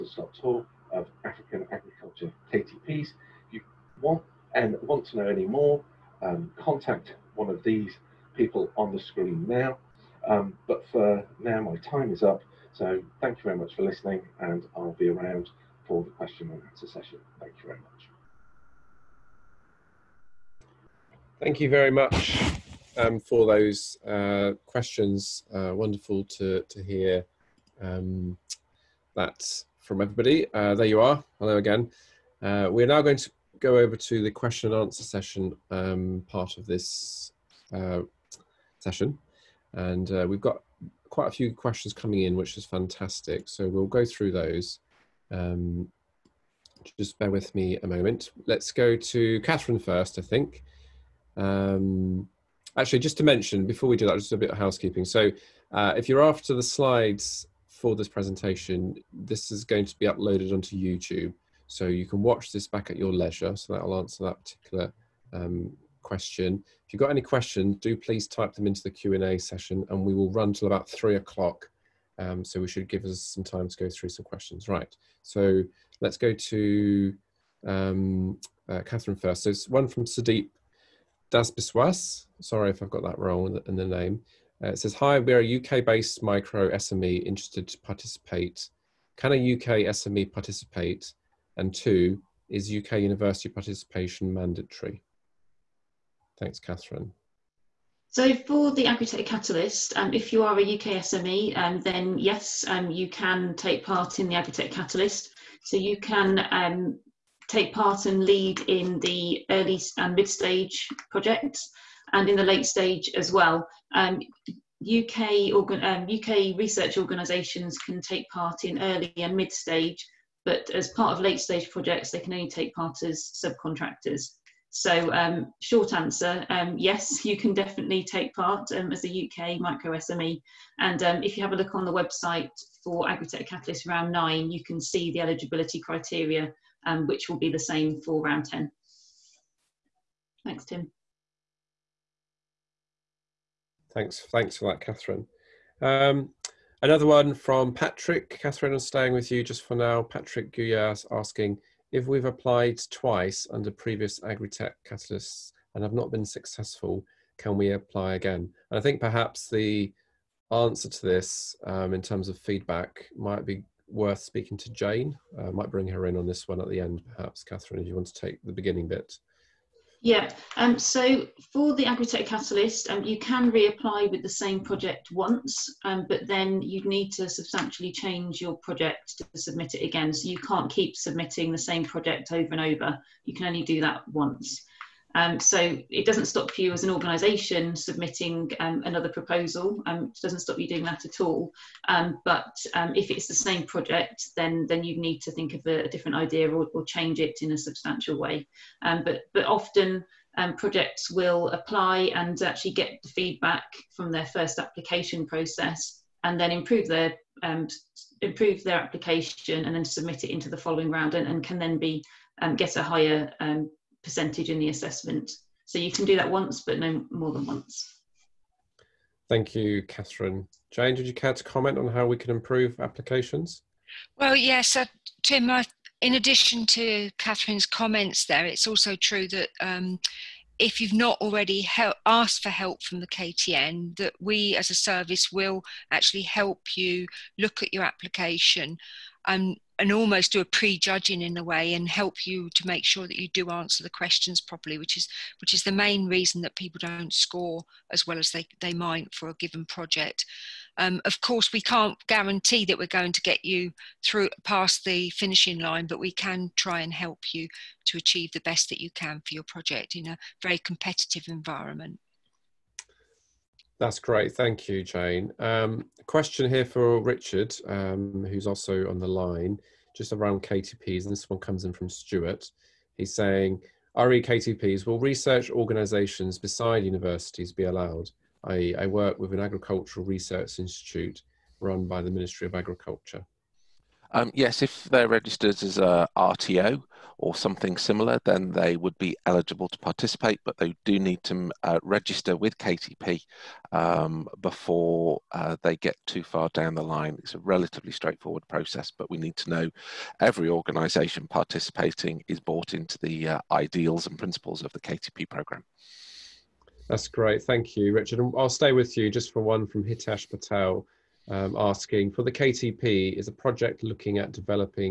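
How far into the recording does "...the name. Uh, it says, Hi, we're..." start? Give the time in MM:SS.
01:23.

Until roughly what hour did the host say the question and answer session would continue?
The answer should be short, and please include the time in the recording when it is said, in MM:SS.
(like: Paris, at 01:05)
3 o'clock, at 01:10.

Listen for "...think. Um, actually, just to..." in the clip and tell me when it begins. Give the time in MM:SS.
00:50.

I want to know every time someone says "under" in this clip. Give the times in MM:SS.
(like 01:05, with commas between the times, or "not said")
02:33.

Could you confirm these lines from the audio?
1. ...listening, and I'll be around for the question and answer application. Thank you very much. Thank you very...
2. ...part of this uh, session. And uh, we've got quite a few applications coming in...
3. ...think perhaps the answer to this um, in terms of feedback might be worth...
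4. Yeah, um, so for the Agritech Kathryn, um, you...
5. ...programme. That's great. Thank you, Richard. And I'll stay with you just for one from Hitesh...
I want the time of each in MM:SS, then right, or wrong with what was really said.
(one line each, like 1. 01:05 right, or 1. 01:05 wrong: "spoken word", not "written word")
1. 00:13 wrong: "session", not "application"
2. 00:36 wrong: "questions", not "applications"
3. 02:38 right
4. 02:50 wrong: "Catalyst", not "Kathryn"
5. 05:05 right.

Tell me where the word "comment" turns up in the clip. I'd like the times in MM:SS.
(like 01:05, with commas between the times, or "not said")
03:41, 03:47.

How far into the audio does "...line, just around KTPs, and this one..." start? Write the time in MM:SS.
04:29.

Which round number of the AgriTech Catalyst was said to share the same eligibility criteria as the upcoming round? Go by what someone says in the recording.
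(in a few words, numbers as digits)
Round 9.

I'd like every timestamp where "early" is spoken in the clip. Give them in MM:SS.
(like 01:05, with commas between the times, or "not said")
01:49, 01:58.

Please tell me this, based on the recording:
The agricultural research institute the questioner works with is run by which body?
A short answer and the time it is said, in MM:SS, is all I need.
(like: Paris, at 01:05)
Ministry of Agriculture, at 04:42.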